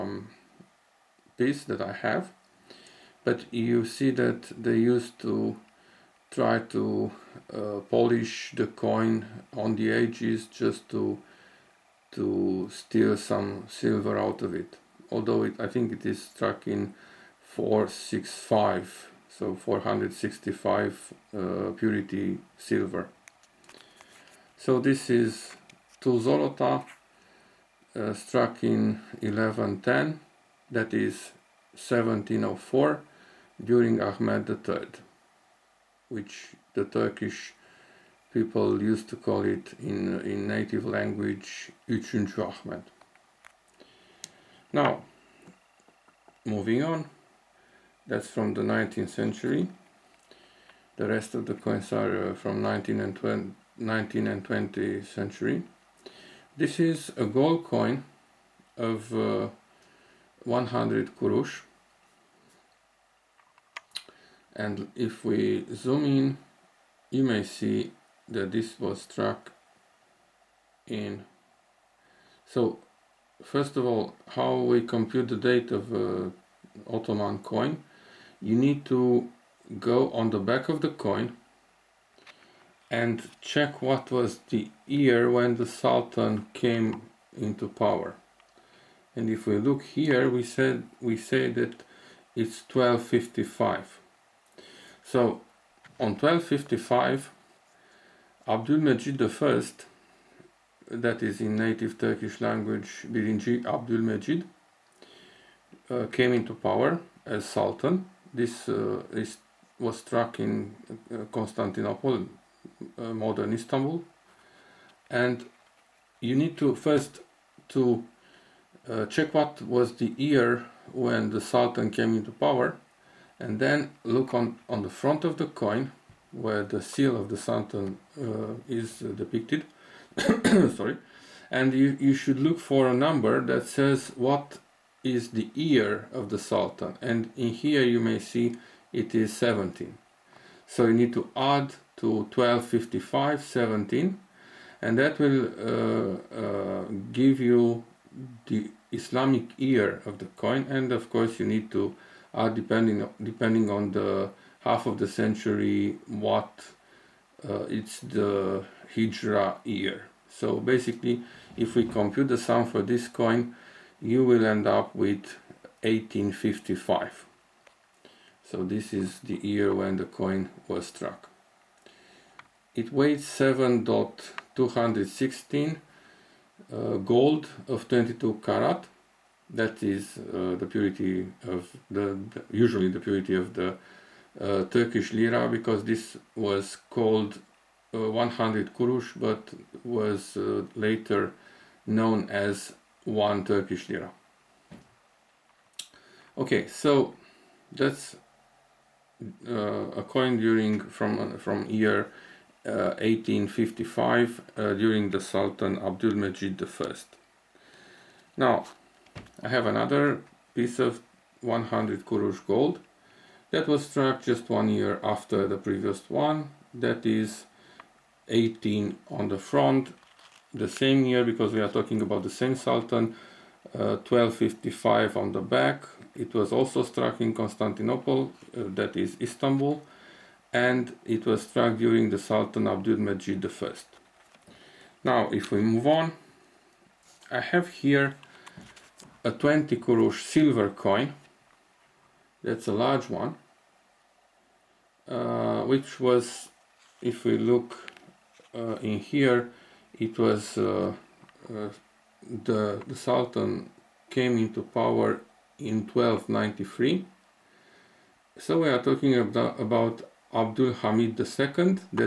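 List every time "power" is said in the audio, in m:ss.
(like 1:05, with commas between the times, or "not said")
1:27, 1:46, 2:02, 4:14.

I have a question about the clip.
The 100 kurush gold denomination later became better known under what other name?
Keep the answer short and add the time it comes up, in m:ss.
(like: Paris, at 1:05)
one Turkish lira, at 3:13.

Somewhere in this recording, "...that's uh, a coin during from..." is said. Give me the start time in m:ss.
3:17.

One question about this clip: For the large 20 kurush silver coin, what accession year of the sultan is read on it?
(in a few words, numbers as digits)
1293.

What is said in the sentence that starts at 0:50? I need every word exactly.
The rest of the coins are uh, from 19 and 20, 19 and 20th century.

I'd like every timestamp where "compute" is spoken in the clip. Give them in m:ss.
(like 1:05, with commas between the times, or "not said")
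1:14, 2:41.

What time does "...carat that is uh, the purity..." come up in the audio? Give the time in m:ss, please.
2:58.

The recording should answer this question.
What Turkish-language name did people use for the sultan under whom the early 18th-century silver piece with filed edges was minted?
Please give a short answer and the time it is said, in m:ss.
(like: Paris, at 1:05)
Üçüncü Ahmed, at 0:41.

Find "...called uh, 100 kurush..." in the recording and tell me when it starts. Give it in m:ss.
3:06.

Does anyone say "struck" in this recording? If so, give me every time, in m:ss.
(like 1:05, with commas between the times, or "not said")
0:16, 0:28, 1:09, 1:50, 2:50, 3:33, 3:46, 3:51.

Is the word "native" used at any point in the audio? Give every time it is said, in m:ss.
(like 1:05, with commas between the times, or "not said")
0:40, 1:41.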